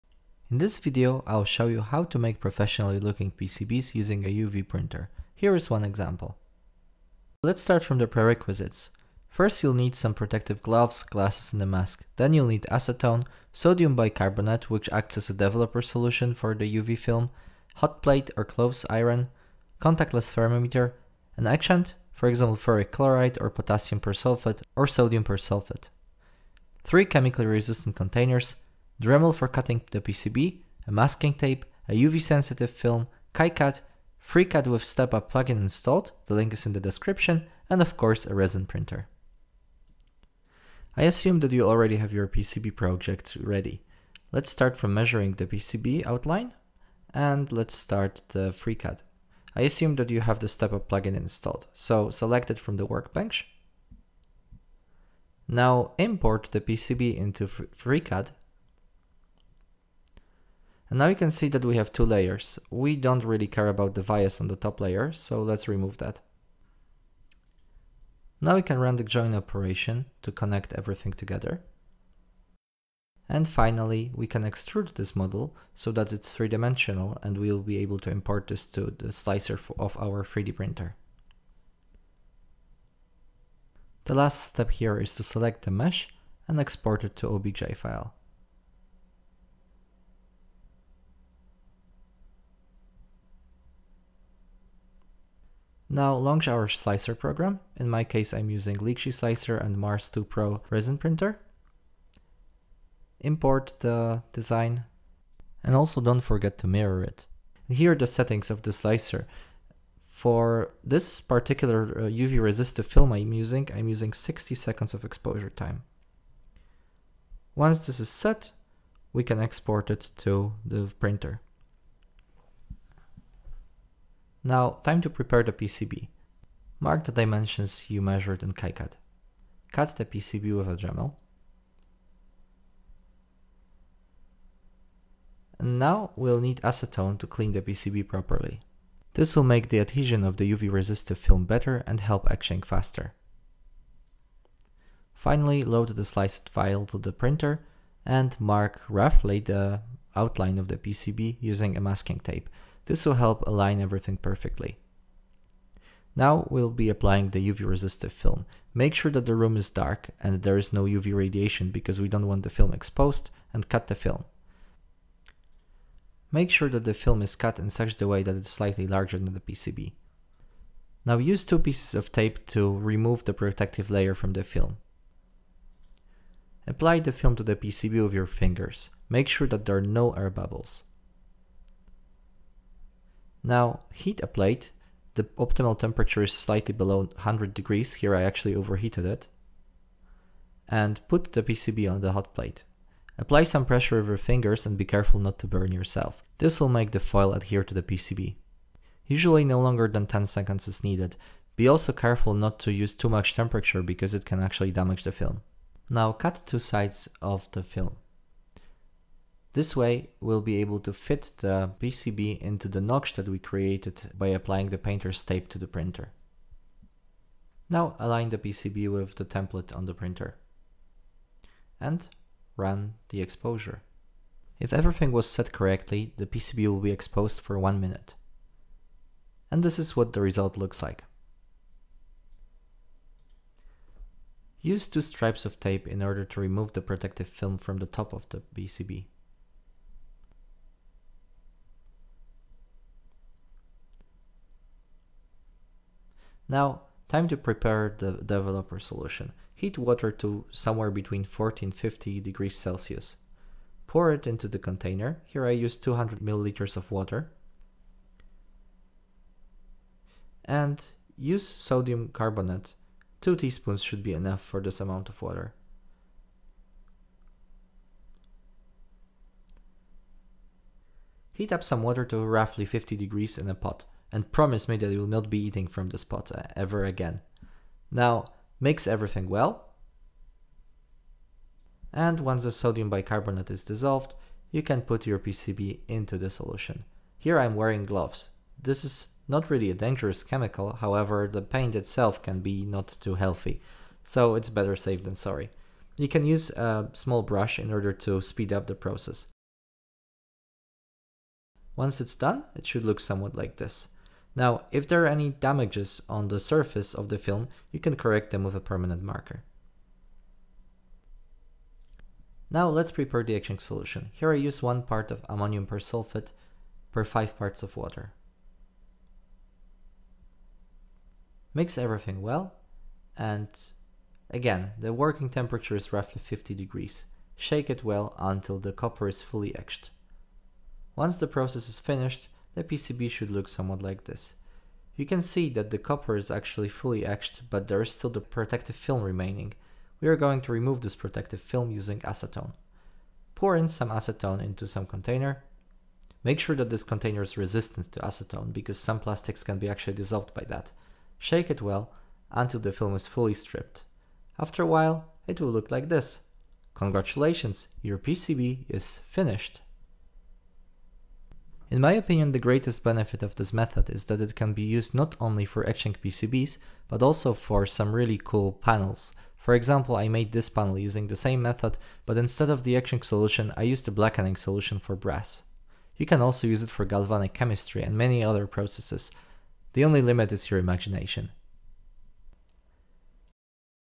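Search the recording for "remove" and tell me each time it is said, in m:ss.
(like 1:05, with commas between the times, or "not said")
1:05, 2:52, 3:56, 5:40.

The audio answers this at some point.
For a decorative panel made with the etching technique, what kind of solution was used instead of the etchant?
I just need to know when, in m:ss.
6:13.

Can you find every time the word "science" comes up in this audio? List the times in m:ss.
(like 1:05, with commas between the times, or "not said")
not said.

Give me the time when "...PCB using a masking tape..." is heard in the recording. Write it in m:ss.
2:30.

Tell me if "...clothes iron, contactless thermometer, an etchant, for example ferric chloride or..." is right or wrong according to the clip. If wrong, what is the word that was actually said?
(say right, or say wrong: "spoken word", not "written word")
right.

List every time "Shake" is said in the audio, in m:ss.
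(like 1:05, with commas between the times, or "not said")
5:27, 5:51.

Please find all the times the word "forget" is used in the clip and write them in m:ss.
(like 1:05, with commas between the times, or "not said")
1:46.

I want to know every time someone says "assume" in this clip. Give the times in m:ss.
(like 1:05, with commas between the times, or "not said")
0:41, 0:49.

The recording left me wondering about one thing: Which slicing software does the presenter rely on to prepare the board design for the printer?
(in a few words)
Lychee Slicer.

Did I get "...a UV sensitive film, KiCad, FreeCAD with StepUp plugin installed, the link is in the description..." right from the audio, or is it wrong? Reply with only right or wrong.
right.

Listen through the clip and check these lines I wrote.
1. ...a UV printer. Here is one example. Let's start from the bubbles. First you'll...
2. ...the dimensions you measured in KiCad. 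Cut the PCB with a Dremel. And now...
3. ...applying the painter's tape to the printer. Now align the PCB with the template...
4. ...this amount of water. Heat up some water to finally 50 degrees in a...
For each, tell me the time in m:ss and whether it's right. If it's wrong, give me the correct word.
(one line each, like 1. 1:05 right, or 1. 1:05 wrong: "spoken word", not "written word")
1. 0:04 wrong: "prerequisites", not "bubbles"
2. 2:07 right
3. 3:34 right
4. 4:24 wrong: "roughly", not "finally".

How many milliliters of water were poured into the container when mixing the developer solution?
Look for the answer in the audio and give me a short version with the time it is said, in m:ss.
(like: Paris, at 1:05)
200, at 4:15.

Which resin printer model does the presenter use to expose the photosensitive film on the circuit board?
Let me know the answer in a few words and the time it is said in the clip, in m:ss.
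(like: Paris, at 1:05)
Mars 2 Pro, at 1:39.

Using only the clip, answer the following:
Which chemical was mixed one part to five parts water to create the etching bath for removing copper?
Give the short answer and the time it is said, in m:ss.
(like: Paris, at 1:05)
ammonium persulfate, at 5:15.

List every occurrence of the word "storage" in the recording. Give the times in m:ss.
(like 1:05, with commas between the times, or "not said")
not said.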